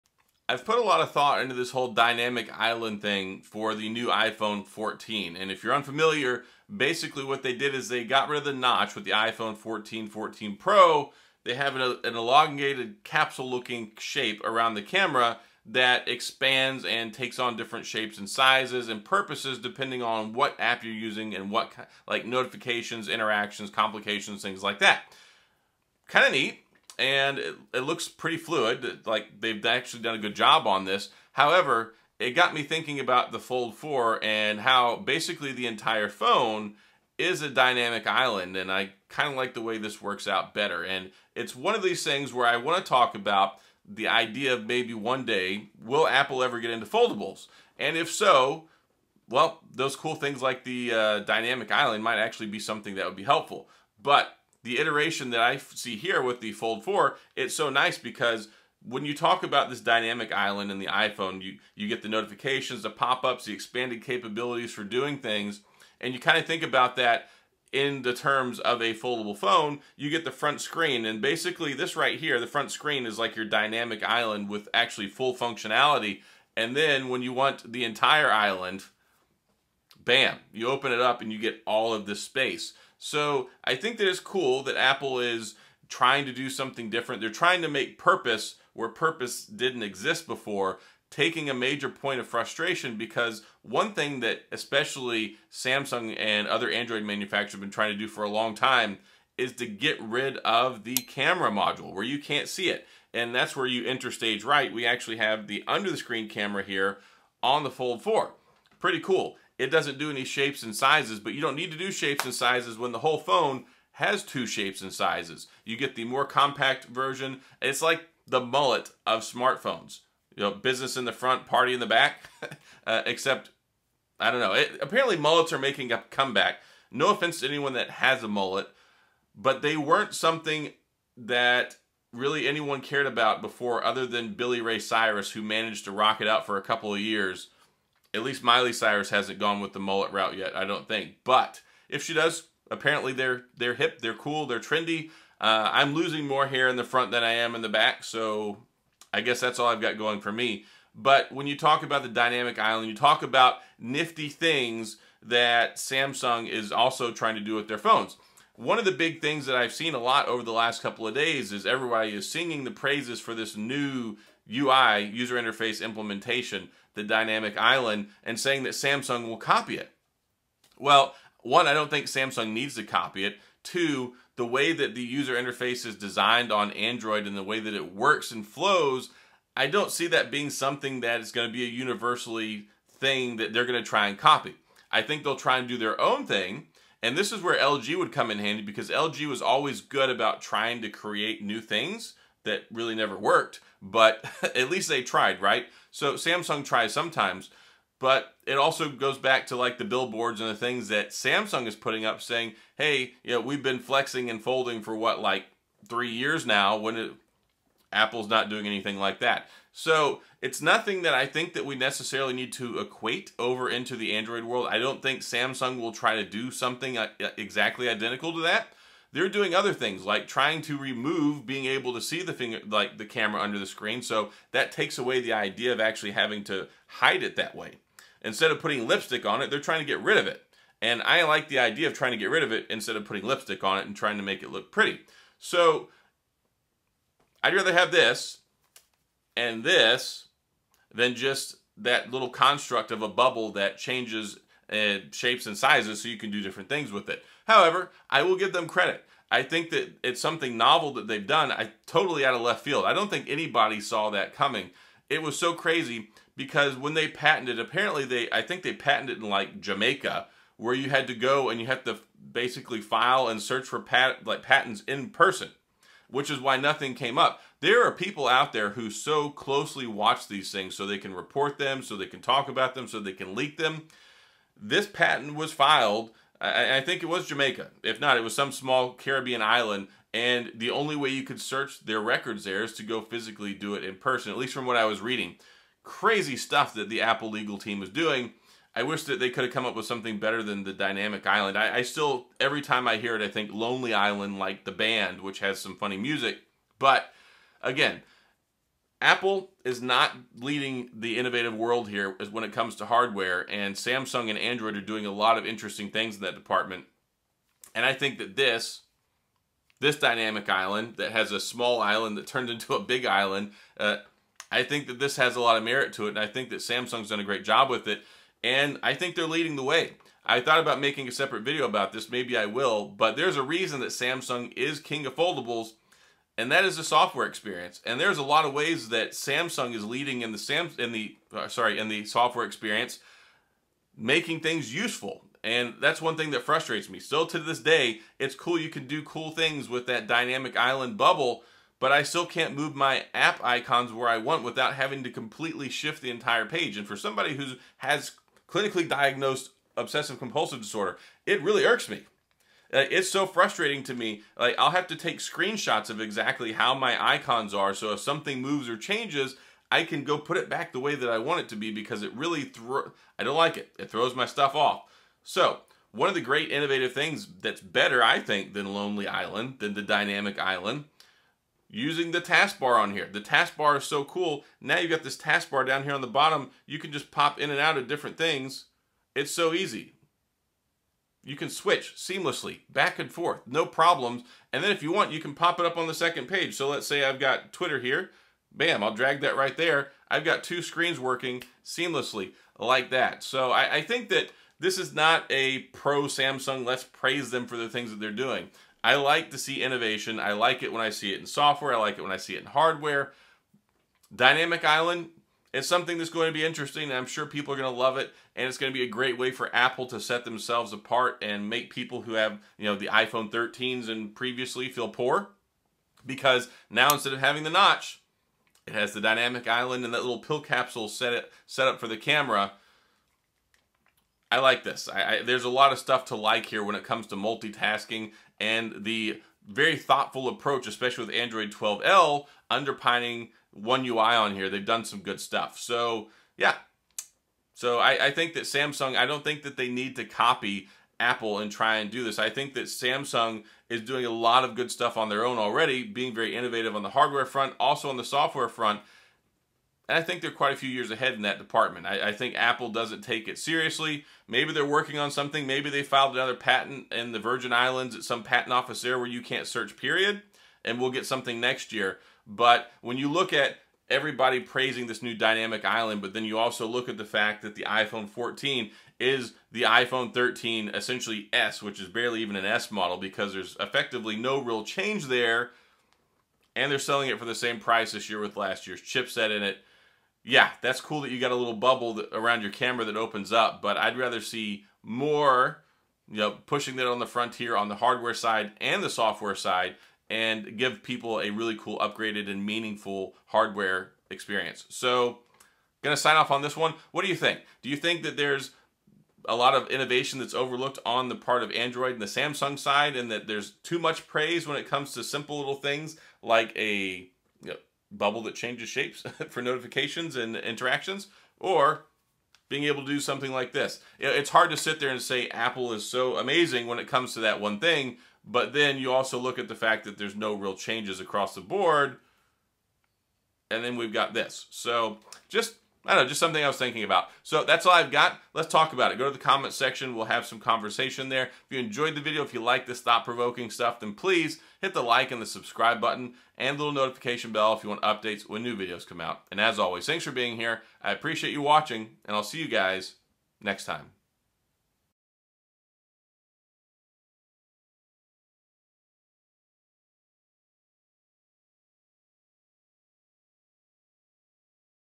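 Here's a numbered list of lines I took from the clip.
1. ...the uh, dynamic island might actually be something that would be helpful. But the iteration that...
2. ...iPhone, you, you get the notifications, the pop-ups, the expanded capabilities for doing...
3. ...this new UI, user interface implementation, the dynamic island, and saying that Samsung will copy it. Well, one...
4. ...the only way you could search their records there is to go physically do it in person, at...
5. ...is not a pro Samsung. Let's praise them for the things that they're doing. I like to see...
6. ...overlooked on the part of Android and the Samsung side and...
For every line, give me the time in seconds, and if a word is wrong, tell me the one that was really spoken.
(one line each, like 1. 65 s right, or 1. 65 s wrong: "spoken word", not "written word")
1. 50 s right
2. 60 s right
3. 163 s right
4. 280 s right
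5. 394 s right
6. 500 s right.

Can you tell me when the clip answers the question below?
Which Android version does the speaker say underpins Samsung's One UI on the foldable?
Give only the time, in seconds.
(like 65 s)
431 s.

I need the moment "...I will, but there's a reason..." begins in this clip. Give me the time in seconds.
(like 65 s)
322 s.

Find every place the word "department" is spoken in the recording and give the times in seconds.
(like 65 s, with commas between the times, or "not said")
306 s, 451 s.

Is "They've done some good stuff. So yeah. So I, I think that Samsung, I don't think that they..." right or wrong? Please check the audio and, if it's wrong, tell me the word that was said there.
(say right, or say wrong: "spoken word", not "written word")
right.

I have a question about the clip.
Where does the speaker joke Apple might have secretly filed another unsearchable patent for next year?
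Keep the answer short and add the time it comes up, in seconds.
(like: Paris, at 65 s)
Virgin Islands, at 457 s.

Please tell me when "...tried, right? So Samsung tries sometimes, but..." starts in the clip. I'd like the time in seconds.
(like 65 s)
195 s.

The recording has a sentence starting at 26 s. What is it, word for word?
Kind of neat and it, it looks pretty fluid.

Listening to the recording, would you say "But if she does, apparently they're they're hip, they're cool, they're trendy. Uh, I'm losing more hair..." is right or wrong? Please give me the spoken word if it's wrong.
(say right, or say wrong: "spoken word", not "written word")
right.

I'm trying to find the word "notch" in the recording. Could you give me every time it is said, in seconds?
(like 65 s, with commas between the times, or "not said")
8 s, 417 s.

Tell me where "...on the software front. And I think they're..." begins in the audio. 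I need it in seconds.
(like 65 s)
447 s.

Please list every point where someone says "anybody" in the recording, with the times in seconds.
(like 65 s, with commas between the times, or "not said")
253 s.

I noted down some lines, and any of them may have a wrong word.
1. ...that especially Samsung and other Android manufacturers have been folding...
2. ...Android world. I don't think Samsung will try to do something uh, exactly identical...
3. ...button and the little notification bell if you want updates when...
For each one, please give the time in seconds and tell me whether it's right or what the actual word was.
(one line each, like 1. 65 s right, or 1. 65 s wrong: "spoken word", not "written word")
1. 94 s wrong: "trying", not "folding"
2. 214 s right
3. 535 s right.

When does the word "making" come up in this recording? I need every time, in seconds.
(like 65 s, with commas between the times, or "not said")
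125 s, 320 s, 333 s.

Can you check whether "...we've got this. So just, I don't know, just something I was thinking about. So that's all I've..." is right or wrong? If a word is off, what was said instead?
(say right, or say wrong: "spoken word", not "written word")
right.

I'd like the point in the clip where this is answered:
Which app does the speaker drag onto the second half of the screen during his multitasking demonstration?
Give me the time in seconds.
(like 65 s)
387 s.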